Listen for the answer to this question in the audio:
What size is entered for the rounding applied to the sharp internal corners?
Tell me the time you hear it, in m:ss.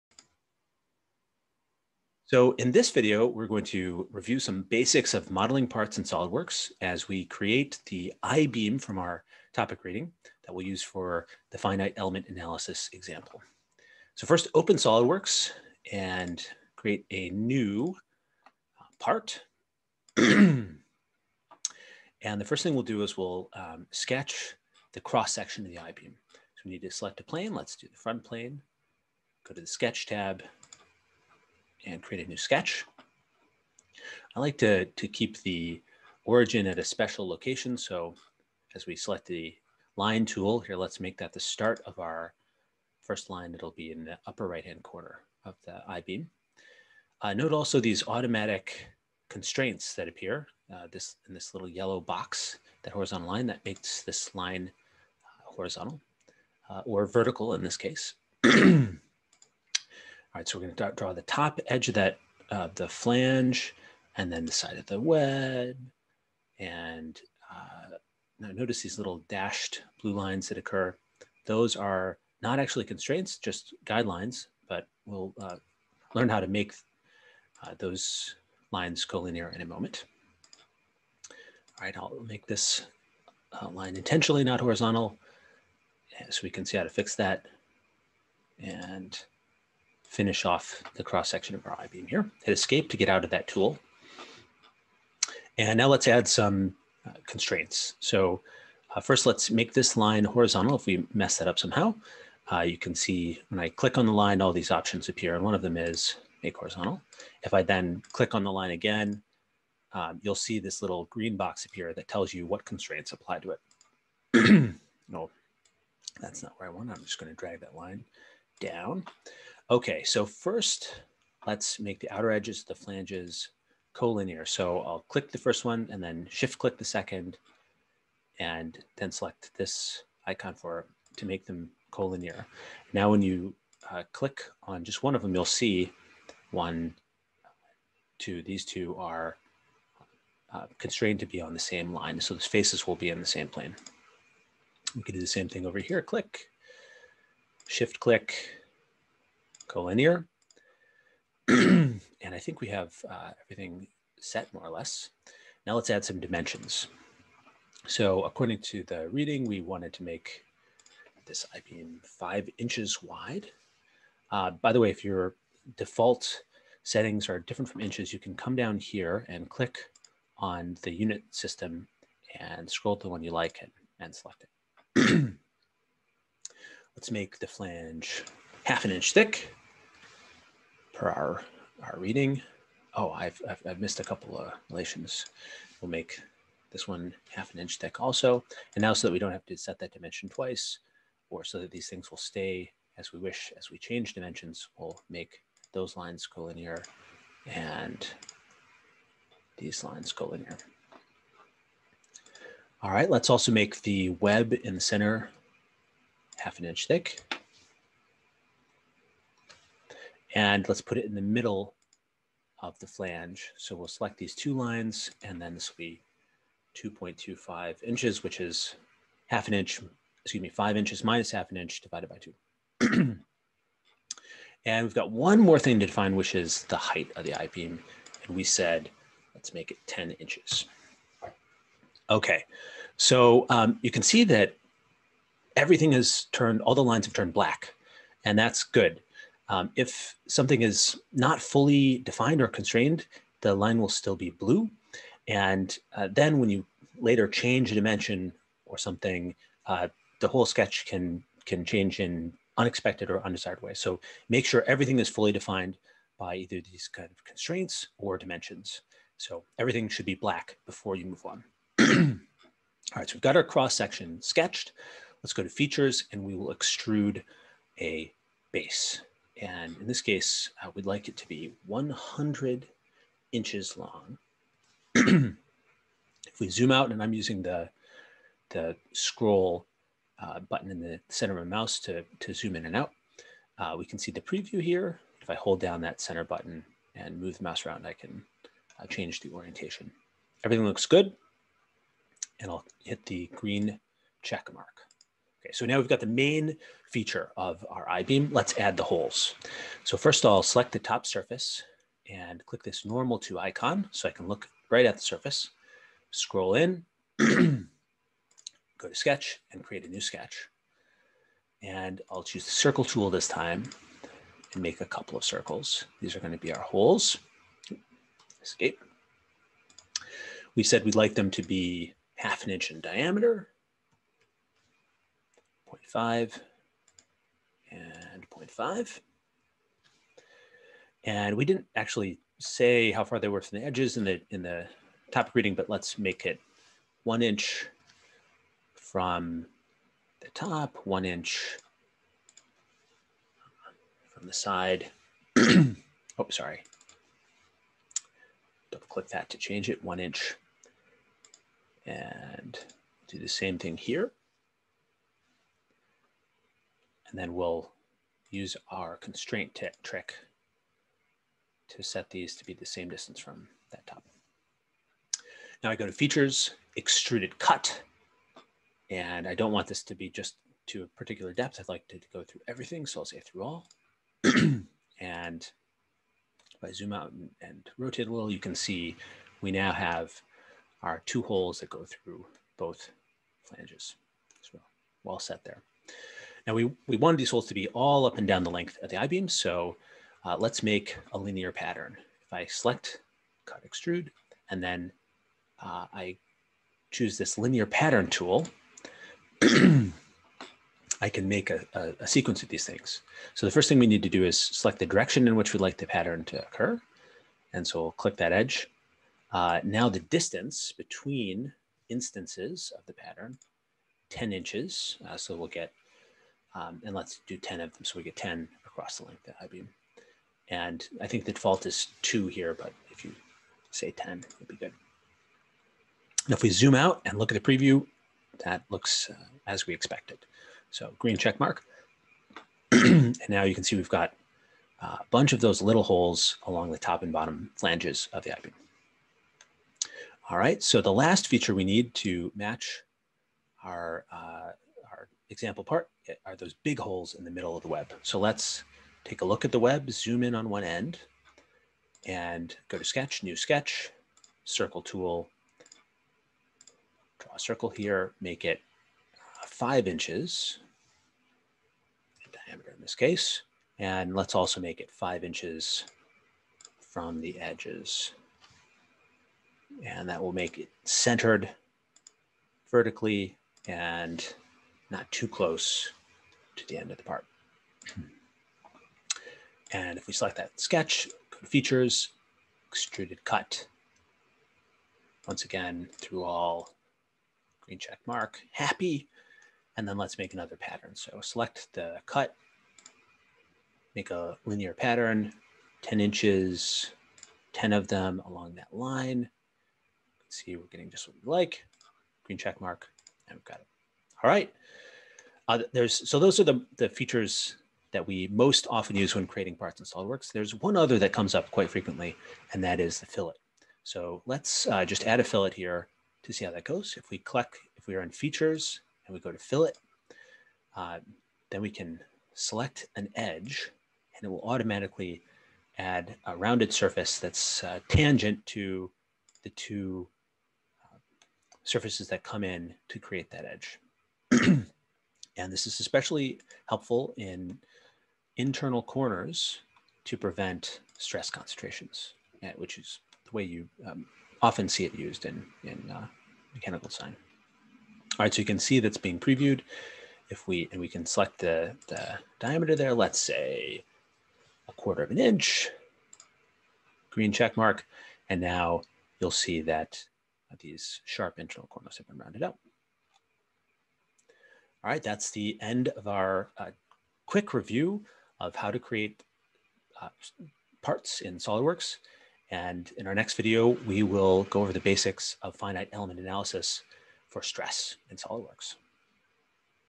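9:14.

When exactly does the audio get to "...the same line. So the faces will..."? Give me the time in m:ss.
2:21.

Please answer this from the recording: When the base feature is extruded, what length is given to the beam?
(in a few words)
100 inches.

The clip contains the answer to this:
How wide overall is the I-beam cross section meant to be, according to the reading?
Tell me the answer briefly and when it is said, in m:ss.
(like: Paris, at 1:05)
5 inches, at 2:42.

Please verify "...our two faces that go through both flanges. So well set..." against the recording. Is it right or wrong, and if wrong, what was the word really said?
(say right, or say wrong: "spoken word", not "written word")
wrong: "holes", not "faces".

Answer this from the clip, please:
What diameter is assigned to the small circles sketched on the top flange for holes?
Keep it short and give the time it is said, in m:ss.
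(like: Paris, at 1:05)
0.5 inches, at 5:22.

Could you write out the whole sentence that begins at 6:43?
So the first thing we need to do is select the direction in which we'd like the pattern to occur.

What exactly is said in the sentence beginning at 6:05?
Now I go to features, extruded cut.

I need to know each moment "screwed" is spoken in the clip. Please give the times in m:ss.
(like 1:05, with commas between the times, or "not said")
not said.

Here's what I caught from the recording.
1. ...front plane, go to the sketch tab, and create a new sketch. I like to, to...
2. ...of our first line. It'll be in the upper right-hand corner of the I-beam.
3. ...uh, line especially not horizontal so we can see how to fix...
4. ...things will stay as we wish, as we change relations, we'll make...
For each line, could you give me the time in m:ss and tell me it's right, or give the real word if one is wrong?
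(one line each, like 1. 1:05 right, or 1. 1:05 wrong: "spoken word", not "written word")
1. 0:27 right
2. 0:41 right
3. 1:23 wrong: "intentionally", not "especially"
4. 3:11 wrong: "dimensions", not "relations".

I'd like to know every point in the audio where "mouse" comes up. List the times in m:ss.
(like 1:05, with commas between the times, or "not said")
4:41, 4:47.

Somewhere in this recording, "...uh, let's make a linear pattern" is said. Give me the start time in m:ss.
6:30.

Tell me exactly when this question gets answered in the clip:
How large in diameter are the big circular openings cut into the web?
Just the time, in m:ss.
7:39.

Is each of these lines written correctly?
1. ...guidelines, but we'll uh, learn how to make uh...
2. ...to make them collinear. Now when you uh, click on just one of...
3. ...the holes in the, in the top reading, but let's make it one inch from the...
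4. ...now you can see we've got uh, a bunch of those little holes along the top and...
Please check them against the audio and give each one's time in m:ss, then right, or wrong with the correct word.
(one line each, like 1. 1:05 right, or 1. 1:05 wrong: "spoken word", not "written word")
1. 1:13 right
2. 2:11 right
3. 5:33 wrong: "edges", not "holes"
4. 7:13 right.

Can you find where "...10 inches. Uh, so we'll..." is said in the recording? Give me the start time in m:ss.
6:54.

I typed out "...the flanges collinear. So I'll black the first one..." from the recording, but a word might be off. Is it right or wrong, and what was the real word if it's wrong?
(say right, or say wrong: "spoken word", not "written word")
wrong: "click", not "black".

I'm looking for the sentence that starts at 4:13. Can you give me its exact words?
So make sure everything is fully defined by either these kind of constraints or dimensions.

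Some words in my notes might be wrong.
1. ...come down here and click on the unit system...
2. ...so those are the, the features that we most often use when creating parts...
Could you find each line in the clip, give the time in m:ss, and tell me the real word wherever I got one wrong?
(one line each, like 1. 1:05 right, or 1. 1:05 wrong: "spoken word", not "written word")
1. 2:48 right
2. 8:26 right.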